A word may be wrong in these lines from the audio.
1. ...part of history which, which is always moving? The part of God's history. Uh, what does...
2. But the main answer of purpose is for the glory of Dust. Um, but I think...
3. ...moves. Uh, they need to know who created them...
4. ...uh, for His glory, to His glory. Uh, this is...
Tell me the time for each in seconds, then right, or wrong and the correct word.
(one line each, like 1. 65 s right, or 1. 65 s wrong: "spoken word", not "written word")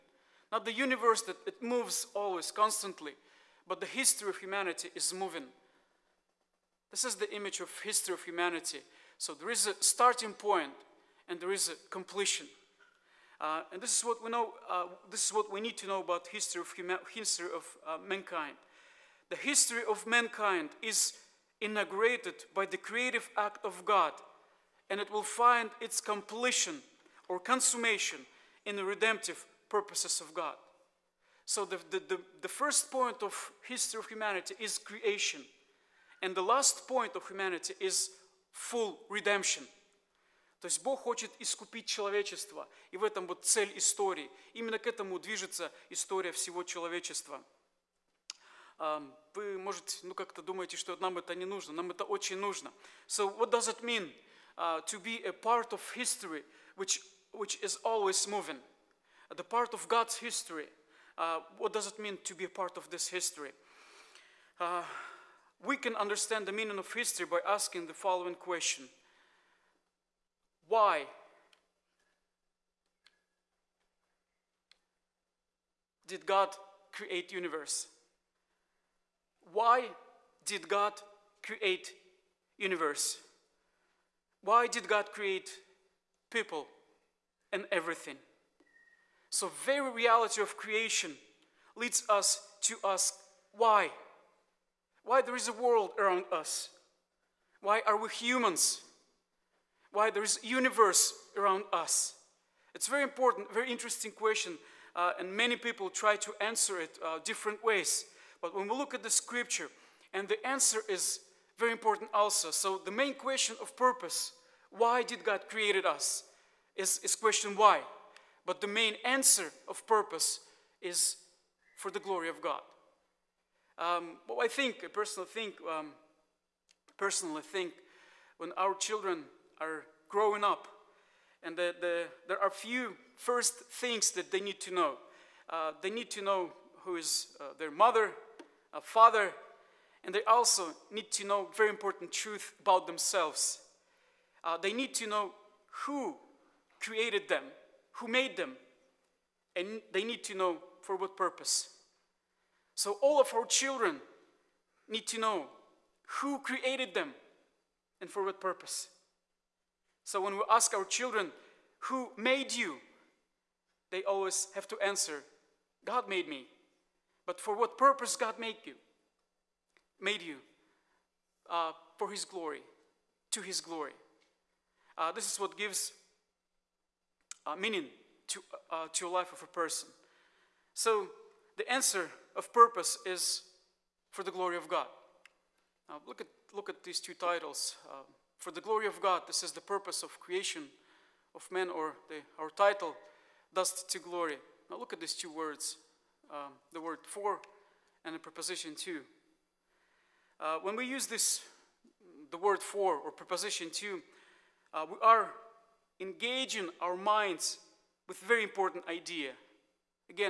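1. 55 s right
2. 118 s wrong: "God", not "Dust"
3. 142 s wrong: "themselves", not "moves"
4. 171 s right.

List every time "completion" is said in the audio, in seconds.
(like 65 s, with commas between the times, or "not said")
11 s, 25 s.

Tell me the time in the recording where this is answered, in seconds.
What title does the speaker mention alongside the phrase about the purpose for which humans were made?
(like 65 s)
193 s.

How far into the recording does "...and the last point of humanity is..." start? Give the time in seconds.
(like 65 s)
36 s.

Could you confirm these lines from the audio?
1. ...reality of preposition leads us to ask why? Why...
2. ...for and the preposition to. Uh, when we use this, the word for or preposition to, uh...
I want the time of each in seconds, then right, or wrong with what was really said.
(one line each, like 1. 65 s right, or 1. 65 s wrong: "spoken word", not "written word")
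1. 89 s wrong: "creation", not "preposition"
2. 197 s right.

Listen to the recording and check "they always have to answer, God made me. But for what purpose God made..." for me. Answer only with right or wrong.
right.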